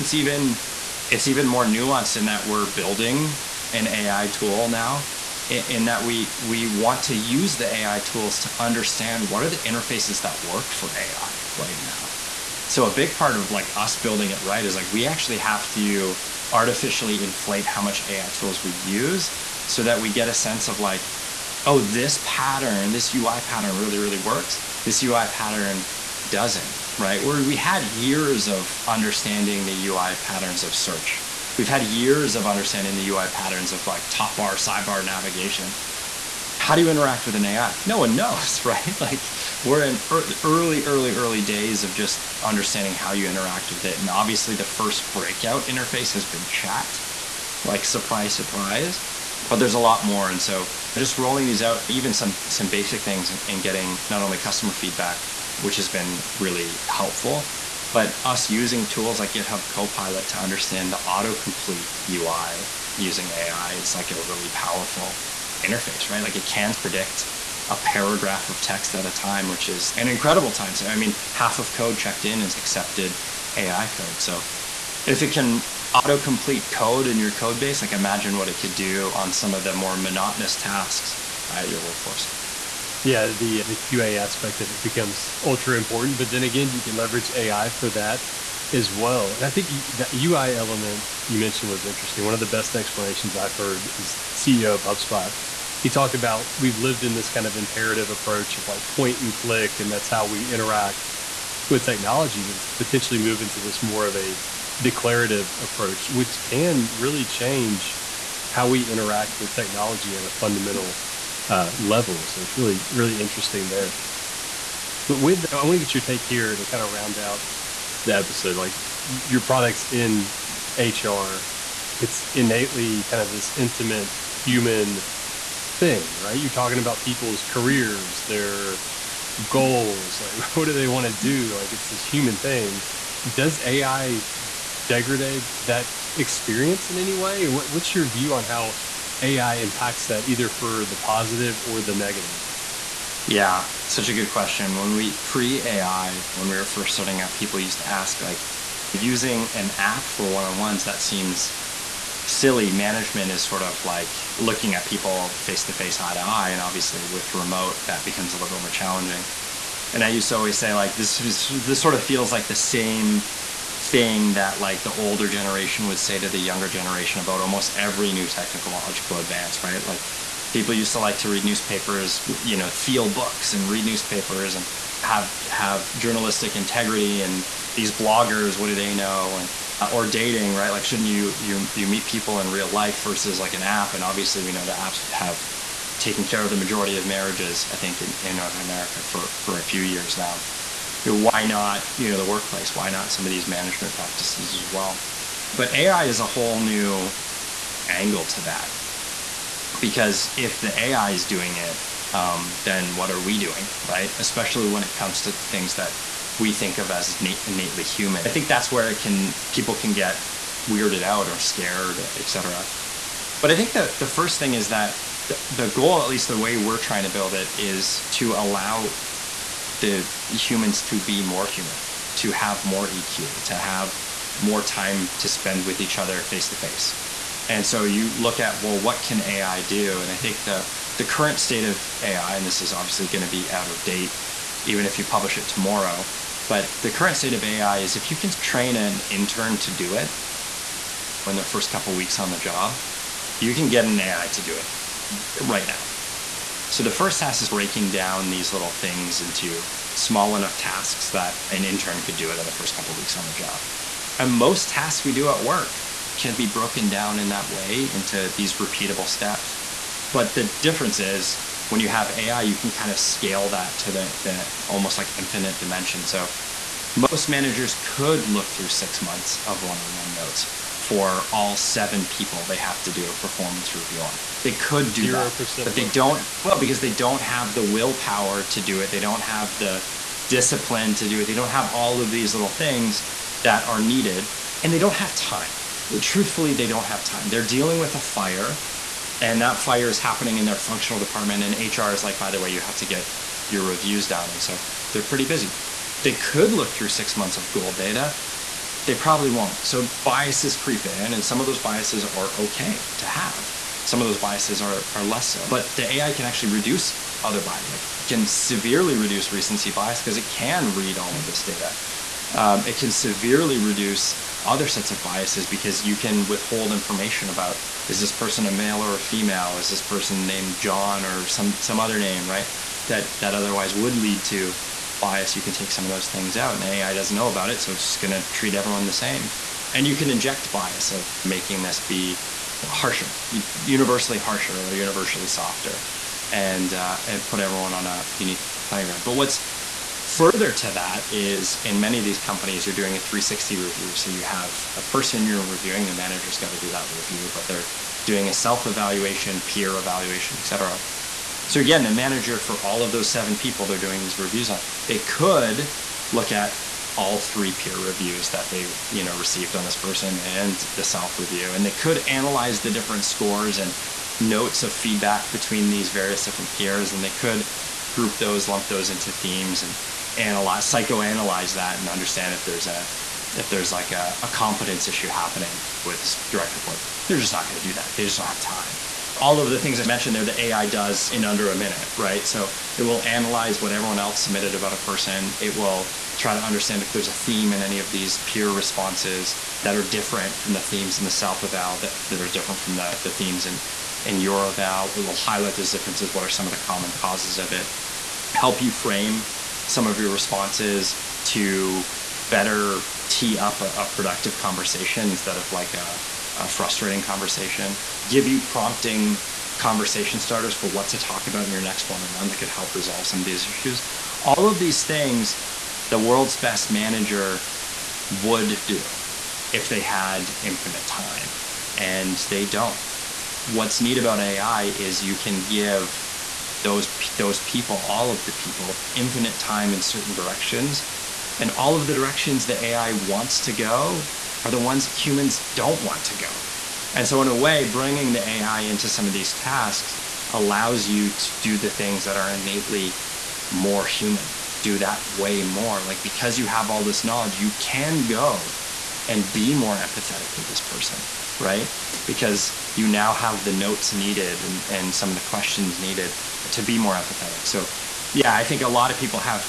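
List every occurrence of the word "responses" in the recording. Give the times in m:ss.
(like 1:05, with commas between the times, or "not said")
6:28, 6:40.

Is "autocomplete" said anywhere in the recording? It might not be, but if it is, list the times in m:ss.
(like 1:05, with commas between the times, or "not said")
1:01, 1:15.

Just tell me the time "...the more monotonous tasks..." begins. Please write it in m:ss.
1:19.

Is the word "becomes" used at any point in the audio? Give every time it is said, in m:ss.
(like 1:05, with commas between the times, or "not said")
1:24, 2:38.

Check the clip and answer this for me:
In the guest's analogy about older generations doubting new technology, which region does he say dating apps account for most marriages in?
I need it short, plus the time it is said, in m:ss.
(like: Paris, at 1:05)
North America, at 3:08.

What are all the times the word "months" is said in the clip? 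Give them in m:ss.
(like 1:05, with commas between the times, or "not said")
4:29, 4:57.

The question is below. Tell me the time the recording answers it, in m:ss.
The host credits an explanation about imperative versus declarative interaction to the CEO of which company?
1:34.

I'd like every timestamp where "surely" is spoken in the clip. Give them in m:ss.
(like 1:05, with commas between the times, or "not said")
not said.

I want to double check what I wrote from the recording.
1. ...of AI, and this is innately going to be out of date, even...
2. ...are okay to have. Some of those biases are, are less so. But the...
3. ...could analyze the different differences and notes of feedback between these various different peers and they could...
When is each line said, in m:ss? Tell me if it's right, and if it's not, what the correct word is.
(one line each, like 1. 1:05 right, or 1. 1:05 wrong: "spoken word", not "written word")
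1. 3:51 wrong: "obviously", not "innately"
2. 5:02 right
3. 6:01 wrong: "scores", not "differences".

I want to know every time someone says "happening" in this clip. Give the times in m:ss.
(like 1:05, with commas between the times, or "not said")
4:50, 6:15.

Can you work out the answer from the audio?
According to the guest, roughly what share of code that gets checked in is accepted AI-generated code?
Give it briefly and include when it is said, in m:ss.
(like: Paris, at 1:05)
half, at 1:11.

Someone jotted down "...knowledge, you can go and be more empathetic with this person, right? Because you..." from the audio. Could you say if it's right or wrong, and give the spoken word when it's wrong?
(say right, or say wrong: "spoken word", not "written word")
right.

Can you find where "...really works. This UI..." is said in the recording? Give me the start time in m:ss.
0:23.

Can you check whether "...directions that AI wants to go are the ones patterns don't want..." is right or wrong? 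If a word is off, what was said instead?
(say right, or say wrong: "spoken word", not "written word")
wrong: "humans", not "patterns".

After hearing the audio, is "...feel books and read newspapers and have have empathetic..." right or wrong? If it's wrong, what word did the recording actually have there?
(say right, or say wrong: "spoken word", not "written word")
wrong: "journalistic", not "empathetic".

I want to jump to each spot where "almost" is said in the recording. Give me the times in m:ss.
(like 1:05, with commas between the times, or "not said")
2:47, 4:24.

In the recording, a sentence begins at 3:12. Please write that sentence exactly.
Why not some of these management practices as well?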